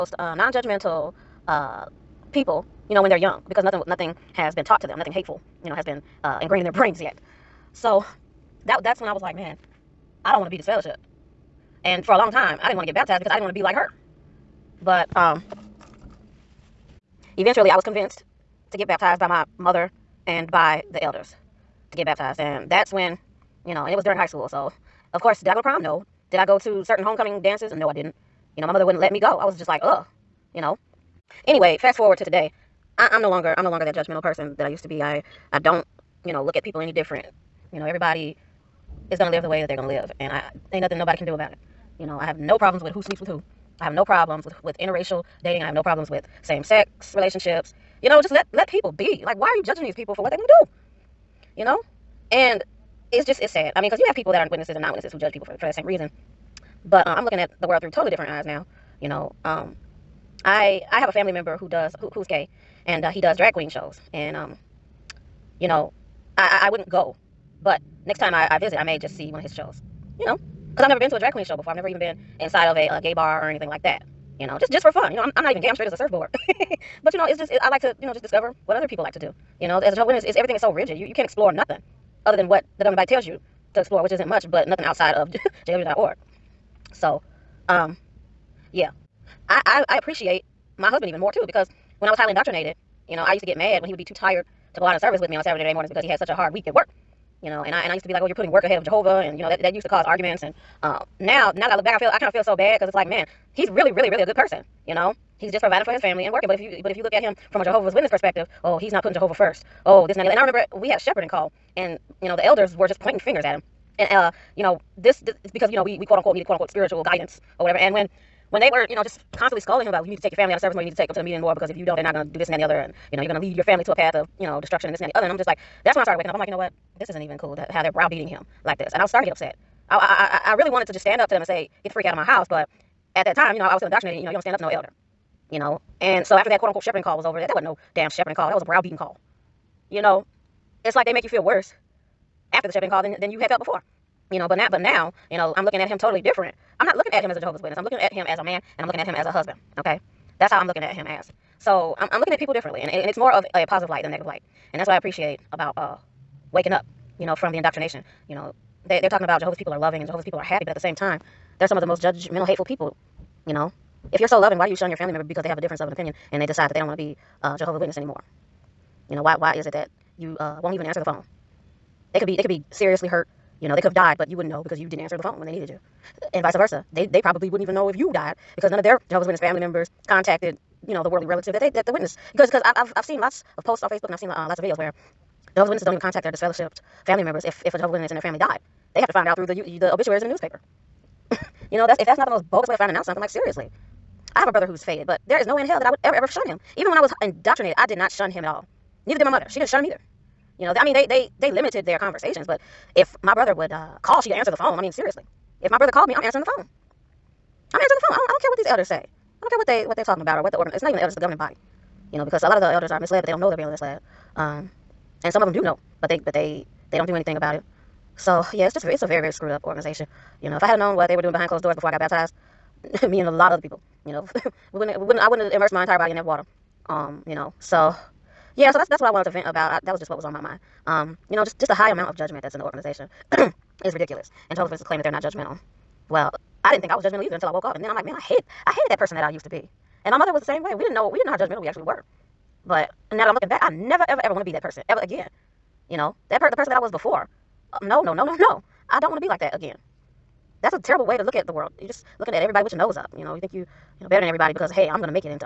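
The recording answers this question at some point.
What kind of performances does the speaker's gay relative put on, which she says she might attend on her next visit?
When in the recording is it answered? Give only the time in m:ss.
1:03.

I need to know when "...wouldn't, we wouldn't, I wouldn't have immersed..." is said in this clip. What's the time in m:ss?
3:44.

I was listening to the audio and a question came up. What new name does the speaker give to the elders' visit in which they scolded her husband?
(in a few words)
A browbeating call.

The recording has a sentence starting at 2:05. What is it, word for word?
And I'm just like, that's when I started waking up.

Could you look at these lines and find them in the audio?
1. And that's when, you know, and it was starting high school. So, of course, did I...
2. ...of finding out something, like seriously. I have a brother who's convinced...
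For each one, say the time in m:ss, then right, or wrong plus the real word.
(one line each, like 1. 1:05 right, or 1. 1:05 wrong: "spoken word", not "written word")
1. 0:22 wrong: "during", not "starting"
2. 3:12 wrong: "faded", not "convinced".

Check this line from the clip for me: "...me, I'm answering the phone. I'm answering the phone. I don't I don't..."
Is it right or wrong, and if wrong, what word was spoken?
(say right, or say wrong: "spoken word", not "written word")
right.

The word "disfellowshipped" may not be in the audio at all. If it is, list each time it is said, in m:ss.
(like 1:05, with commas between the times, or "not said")
0:10, 3:06.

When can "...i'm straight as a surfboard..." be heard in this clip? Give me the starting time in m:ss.
1:15.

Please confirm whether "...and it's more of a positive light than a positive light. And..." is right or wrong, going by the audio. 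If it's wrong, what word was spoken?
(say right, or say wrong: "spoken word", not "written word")
wrong: "negative", not "positive".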